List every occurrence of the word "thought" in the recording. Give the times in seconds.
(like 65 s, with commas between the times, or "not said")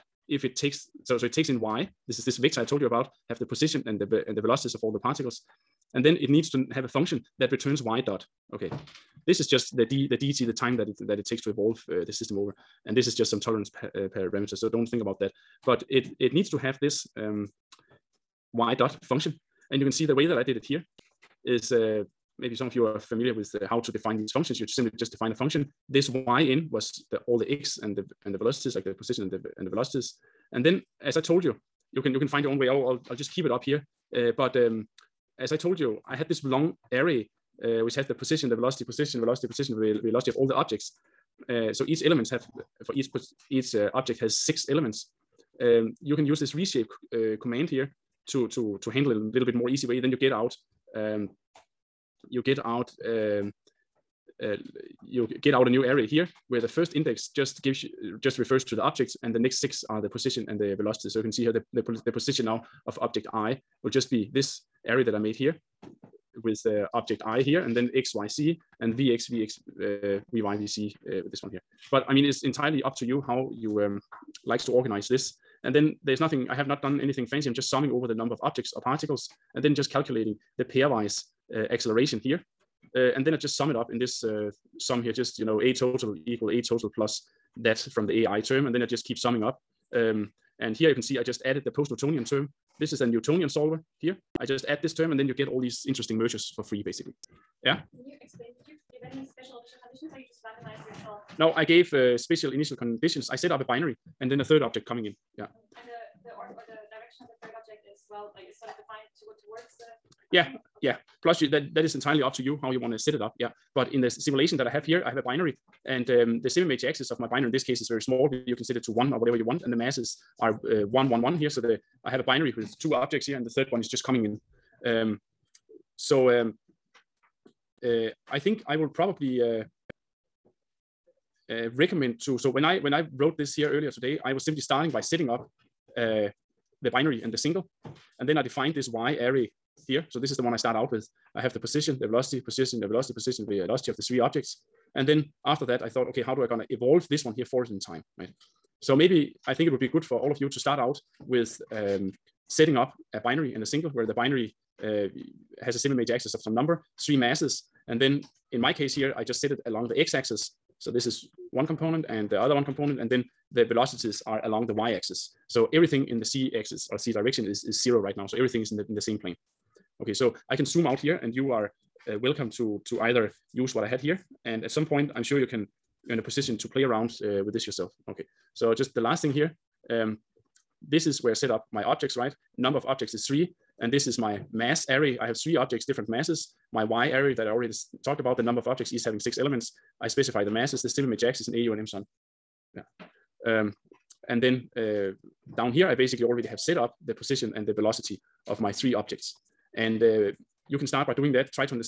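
145 s.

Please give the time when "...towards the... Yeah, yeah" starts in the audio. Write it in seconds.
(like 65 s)
109 s.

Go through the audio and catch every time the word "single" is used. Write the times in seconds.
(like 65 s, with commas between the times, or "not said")
137 s, 153 s.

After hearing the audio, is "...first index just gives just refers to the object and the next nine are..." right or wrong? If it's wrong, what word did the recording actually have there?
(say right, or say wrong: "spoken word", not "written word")
wrong: "six", not "nine".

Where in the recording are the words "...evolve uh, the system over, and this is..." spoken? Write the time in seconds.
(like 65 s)
11 s.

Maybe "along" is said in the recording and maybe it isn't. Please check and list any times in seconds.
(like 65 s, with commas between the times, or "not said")
159 s, 164 s.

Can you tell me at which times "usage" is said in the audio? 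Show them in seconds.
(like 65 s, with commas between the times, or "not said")
not said.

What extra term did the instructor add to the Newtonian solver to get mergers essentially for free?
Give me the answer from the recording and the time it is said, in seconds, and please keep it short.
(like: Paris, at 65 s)
post-Newtonian term, at 91 s.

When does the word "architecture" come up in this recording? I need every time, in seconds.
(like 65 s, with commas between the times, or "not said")
not said.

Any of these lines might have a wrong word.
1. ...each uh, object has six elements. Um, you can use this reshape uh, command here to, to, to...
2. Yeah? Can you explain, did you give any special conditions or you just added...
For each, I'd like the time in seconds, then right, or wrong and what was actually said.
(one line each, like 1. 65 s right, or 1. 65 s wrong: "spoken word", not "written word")
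1. 43 s right
2. 97 s wrong: "randomized", not "added".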